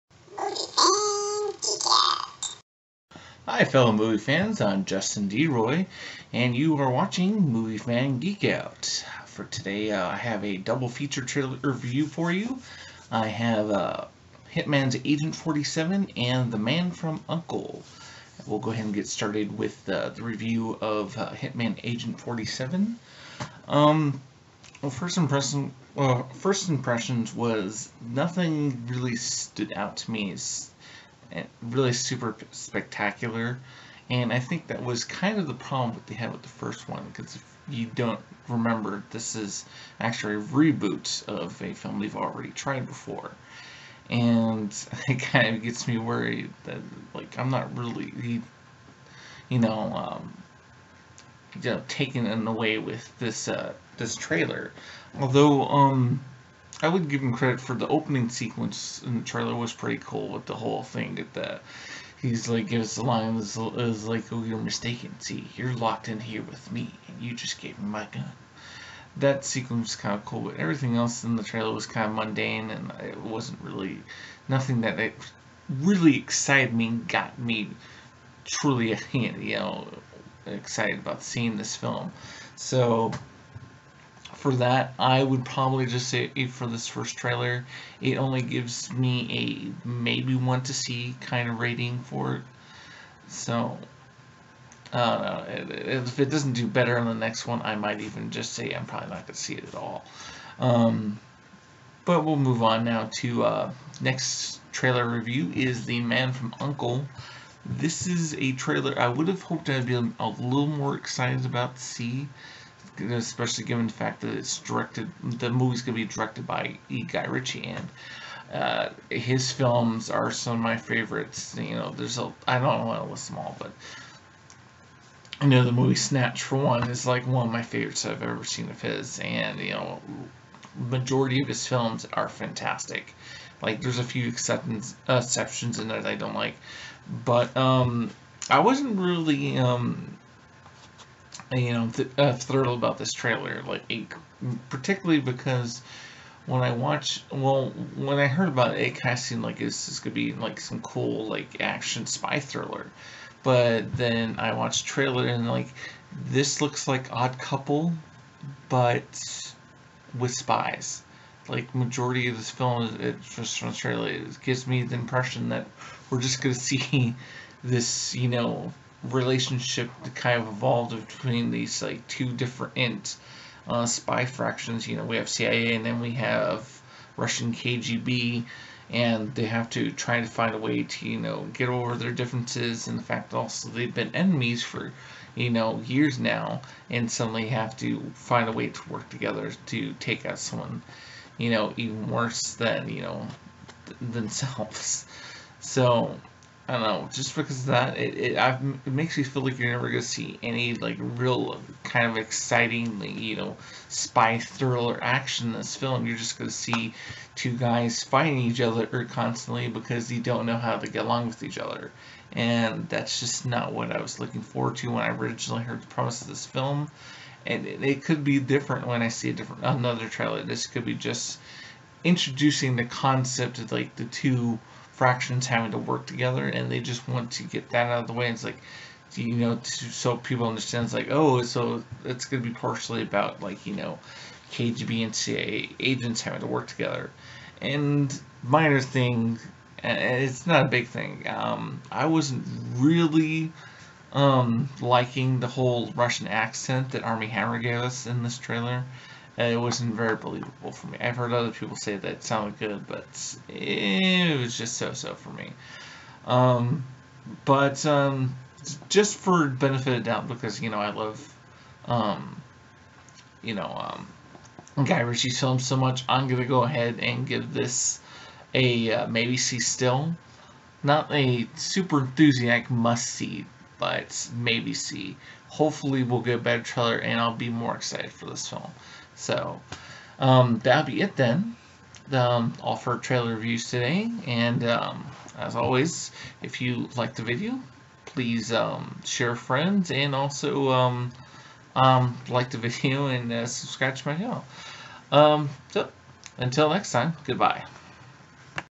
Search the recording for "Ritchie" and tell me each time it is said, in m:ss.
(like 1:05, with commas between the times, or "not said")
1:57, 4:24.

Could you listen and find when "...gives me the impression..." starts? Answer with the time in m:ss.
2:44.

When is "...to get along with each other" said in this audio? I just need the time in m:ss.
3:30.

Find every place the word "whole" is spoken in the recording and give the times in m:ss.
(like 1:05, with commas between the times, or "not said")
1:00, 4:05.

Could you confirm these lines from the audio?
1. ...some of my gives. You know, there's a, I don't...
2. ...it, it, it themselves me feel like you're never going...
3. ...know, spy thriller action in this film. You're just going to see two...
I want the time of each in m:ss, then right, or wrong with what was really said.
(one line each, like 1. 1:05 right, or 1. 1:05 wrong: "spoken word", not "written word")
1. 2:00 wrong: "favorites", not "gives"
2. 3:17 wrong: "makes", not "themselves"
3. 3:23 right.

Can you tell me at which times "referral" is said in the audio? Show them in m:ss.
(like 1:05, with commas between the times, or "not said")
not said.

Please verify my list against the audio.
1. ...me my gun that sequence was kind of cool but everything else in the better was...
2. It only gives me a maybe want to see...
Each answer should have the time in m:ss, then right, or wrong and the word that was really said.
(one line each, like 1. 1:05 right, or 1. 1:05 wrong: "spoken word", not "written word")
1. 1:07 wrong: "trailer", not "better"
2. 1:28 right.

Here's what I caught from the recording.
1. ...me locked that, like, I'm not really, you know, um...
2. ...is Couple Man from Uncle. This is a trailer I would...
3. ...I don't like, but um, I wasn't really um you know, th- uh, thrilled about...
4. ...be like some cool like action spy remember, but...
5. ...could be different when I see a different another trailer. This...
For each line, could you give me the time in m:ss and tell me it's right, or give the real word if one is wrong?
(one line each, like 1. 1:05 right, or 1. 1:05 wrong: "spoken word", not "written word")
1. 0:45 wrong: "worried", not "locked"
2. 1:45 wrong: "The", not "Couple"
3. 2:16 right
4. 2:30 wrong: "thriller", not "remember"
5. 3:38 right.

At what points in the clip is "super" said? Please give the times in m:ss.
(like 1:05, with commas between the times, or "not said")
0:31, 4:31.